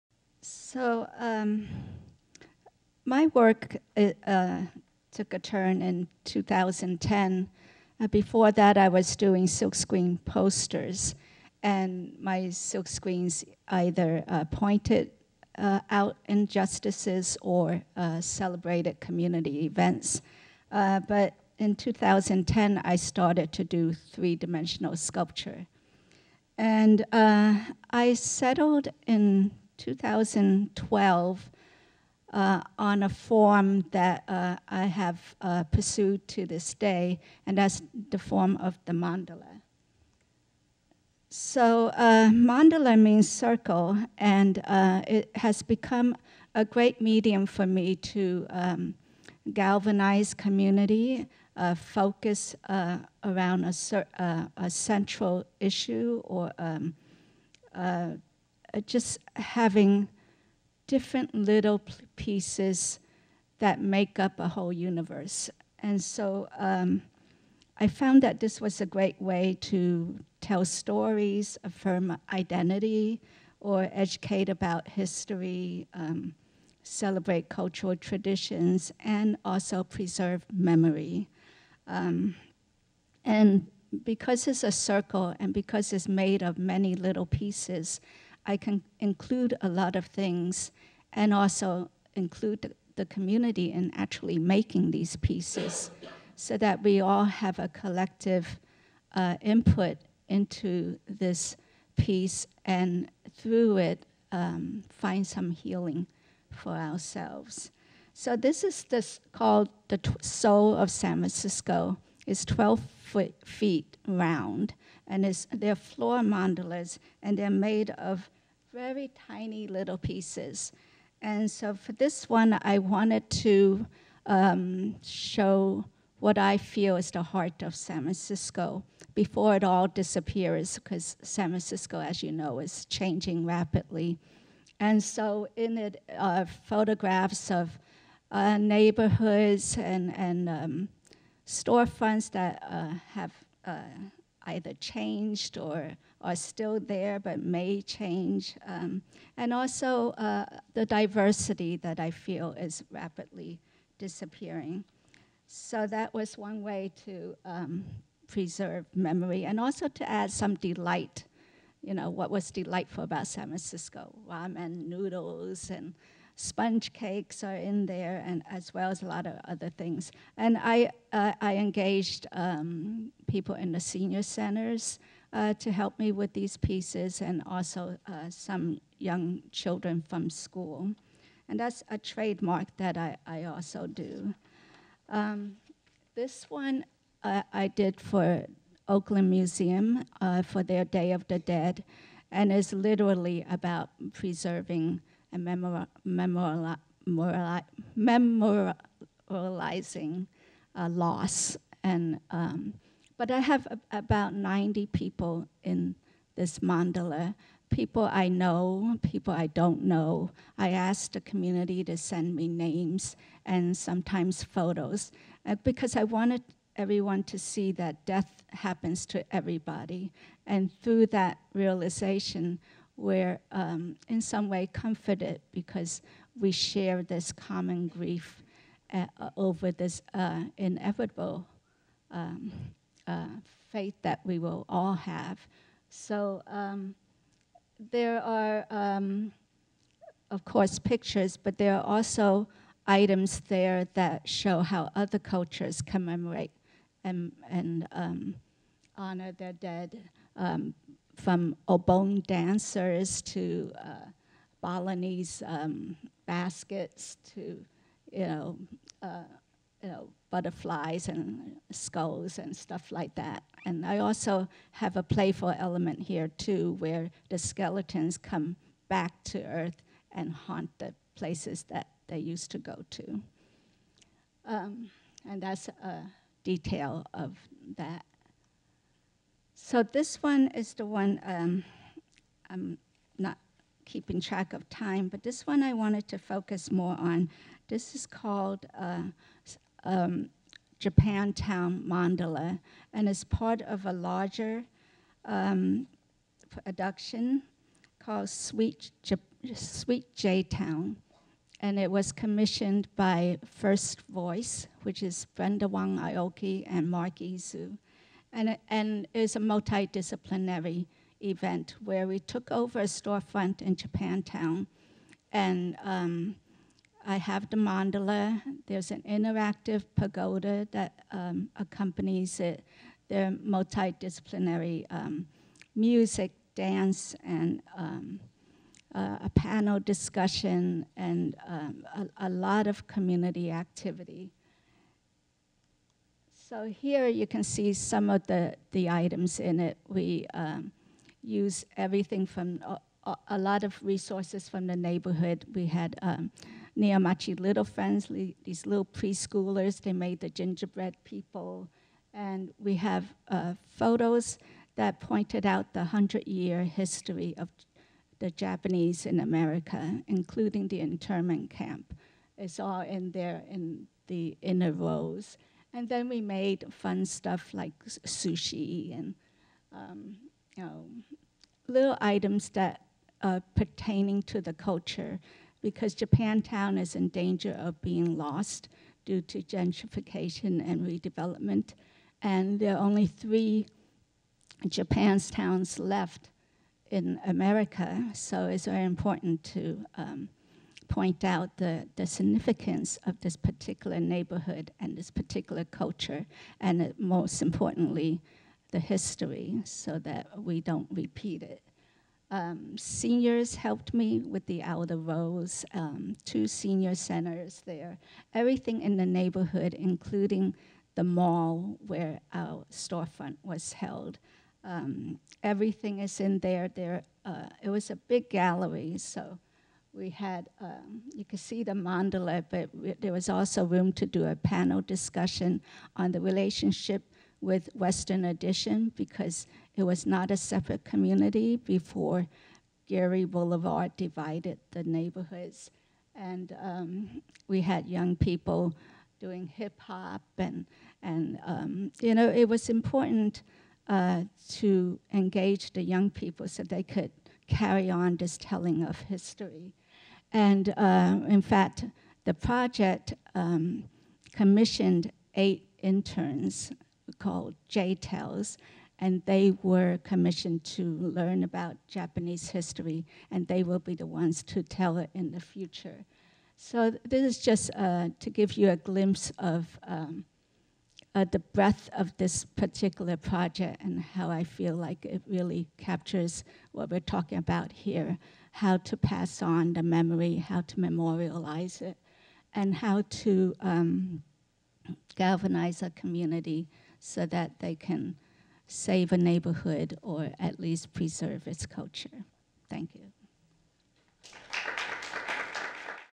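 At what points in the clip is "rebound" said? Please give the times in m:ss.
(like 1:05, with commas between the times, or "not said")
not said.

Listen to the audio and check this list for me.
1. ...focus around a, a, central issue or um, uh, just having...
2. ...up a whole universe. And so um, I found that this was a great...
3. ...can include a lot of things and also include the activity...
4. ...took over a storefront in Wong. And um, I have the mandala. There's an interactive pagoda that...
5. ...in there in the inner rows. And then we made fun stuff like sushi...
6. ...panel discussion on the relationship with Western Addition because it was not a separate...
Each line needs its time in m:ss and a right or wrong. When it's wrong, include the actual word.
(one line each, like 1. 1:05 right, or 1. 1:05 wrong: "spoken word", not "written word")
1. 0:51 right
2. 1:04 right
3. 1:28 wrong: "community", not "activity"
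4. 5:12 wrong: "Japantown", not "Wong"
5. 6:02 right
6. 7:04 right.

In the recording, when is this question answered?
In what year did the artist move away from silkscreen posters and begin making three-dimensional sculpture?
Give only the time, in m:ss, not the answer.
0:20.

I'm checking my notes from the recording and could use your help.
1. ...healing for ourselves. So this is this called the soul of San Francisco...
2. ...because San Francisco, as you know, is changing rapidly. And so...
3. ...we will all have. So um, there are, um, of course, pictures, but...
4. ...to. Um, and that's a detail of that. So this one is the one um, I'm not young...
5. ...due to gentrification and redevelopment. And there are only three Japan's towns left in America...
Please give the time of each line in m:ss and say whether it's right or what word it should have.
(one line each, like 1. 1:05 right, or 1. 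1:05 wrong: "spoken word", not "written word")
1. 1:45 right
2. 2:10 right
3. 3:54 right
4. 4:32 wrong: "keeping", not "young"
5. 6:19 right.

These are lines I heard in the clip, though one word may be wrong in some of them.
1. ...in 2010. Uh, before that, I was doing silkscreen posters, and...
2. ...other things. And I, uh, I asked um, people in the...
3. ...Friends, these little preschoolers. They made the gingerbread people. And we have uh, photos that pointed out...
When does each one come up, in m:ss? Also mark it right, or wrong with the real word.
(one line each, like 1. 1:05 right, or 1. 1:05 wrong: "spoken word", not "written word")
1. 0:05 right
2. 2:49 wrong: "engaged", not "asked"
3. 5:47 right.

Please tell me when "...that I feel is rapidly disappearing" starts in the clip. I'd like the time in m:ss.
2:31.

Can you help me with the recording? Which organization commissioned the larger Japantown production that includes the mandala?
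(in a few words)
First Voice.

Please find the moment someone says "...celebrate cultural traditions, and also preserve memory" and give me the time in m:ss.
1:16.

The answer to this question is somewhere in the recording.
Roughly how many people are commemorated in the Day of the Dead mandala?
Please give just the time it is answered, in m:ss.
3:23.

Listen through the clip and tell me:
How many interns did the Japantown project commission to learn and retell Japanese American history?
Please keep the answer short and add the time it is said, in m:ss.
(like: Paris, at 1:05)
8, at 7:35.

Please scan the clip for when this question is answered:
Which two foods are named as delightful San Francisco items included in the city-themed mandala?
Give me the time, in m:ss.
2:44.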